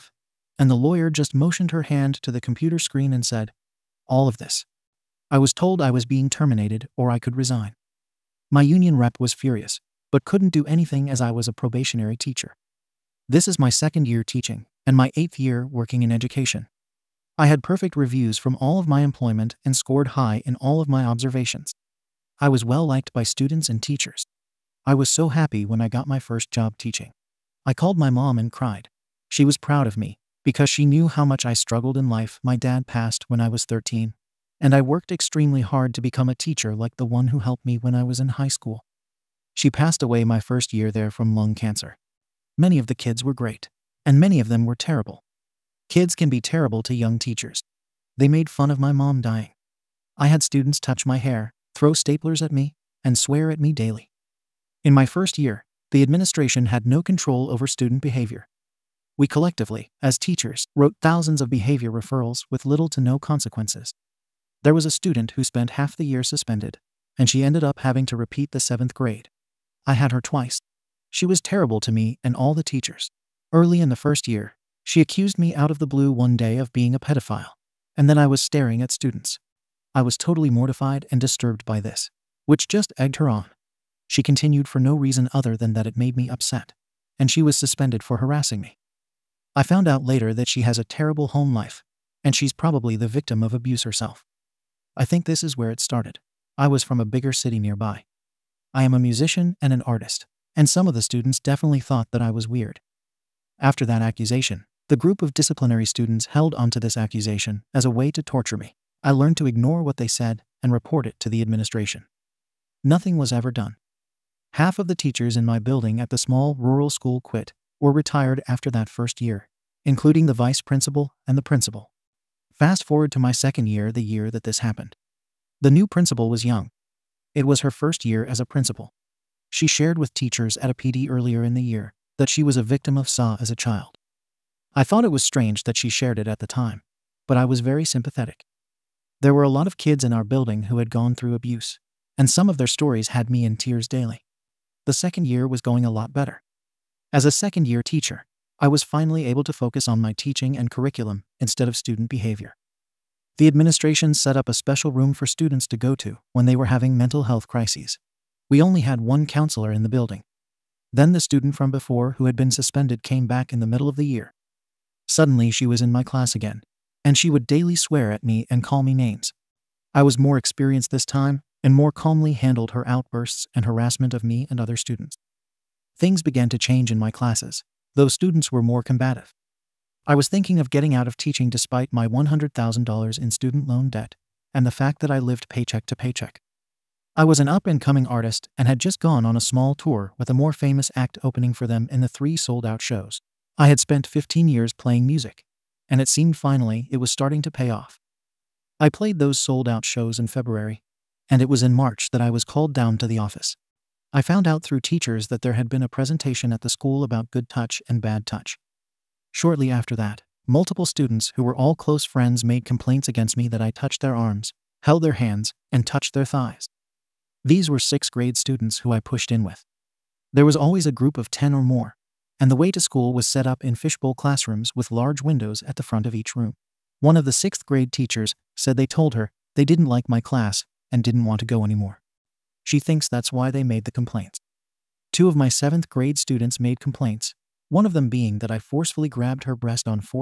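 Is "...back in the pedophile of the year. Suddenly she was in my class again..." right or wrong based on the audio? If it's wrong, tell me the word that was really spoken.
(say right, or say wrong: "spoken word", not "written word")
wrong: "middle", not "pedophile".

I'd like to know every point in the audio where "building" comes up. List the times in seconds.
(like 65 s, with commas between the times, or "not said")
115 s, 140 s, 159 s.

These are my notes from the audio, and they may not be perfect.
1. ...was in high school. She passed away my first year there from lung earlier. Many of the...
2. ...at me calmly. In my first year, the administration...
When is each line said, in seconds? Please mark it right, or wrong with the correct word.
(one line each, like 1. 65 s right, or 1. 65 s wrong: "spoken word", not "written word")
1. 38 s wrong: "cancer", not "earlier"
2. 53 s wrong: "daily", not "calmly".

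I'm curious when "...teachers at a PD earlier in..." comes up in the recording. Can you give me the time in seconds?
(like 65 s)
130 s.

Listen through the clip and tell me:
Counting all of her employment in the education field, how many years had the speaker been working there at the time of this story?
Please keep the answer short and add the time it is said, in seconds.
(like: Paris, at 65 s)
8, at 15 s.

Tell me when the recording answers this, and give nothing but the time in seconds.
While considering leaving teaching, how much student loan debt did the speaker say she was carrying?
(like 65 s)
182 s.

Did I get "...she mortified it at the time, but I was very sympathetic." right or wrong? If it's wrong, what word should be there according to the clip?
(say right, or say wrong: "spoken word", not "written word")
wrong: "shared", not "mortified".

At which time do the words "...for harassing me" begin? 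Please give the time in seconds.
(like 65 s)
88 s.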